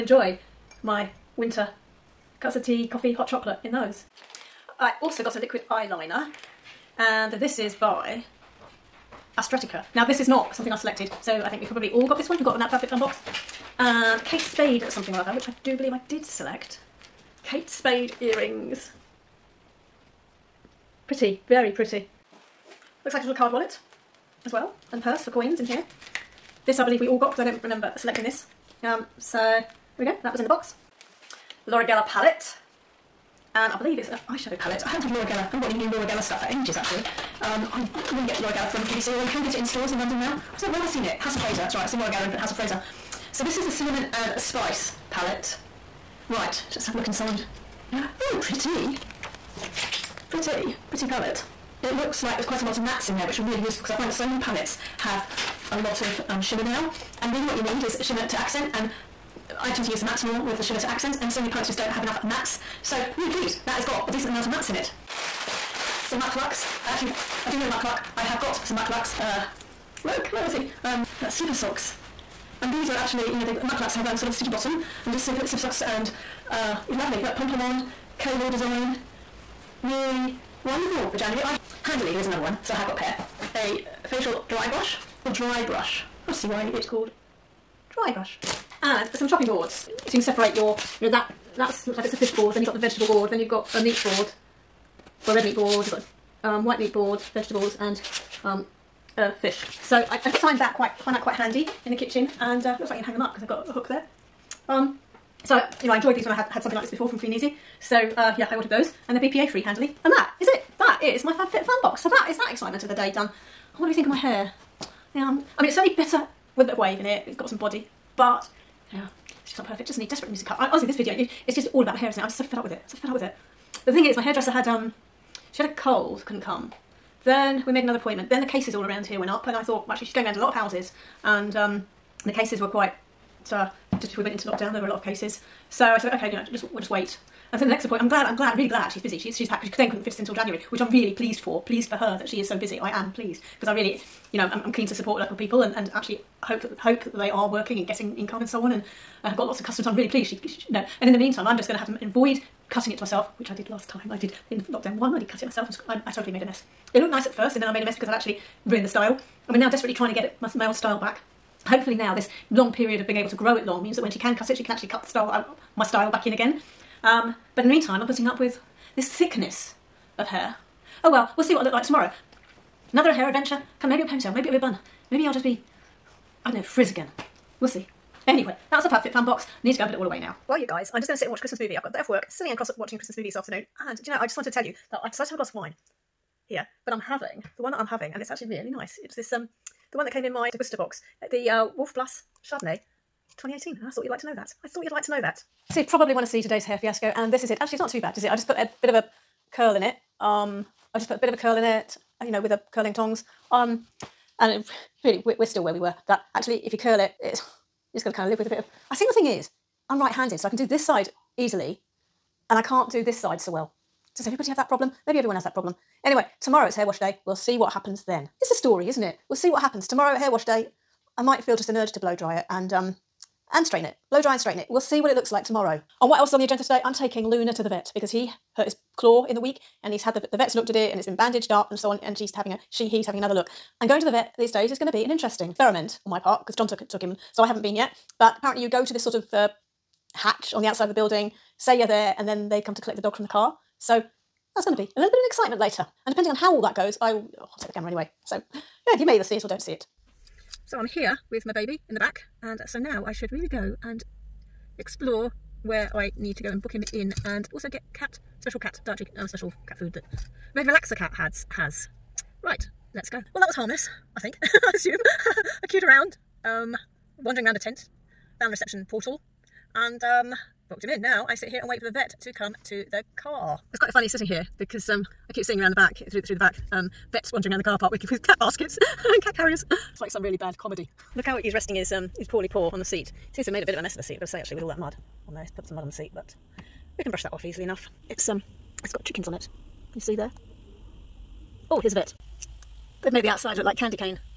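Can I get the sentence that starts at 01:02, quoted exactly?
So really pleased, that has got a decent amount of mattes in it.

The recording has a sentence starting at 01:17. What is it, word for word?
Look, pom pom on, cable design.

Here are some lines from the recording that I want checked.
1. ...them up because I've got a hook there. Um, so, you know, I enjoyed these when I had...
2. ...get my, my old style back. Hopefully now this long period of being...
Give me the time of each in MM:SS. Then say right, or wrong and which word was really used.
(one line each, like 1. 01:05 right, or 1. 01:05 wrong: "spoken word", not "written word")
1. 01:43 right
2. 02:40 right.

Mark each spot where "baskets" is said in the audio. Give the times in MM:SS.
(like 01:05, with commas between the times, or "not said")
04:38.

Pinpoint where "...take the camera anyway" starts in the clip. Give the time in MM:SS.
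04:07.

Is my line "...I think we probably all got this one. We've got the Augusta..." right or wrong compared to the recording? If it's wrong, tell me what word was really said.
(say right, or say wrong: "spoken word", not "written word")
wrong: "Outfit", not "Augusta".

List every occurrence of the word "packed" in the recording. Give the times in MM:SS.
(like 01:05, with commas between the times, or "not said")
02:19.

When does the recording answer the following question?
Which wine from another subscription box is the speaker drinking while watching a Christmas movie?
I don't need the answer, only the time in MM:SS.
03:11.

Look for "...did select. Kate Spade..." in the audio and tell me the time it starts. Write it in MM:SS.
00:16.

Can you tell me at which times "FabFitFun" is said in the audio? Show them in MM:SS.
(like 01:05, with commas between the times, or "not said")
01:51, 02:58.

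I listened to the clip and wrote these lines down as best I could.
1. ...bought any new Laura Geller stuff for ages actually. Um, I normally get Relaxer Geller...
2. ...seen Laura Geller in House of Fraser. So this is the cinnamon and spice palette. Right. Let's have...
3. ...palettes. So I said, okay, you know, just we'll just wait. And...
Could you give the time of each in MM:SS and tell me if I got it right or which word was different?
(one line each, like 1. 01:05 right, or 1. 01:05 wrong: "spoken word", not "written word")
1. 00:35 wrong: "Laura", not "Relaxer"
2. 00:41 right
3. 02:15 wrong: "cases", not "palettes".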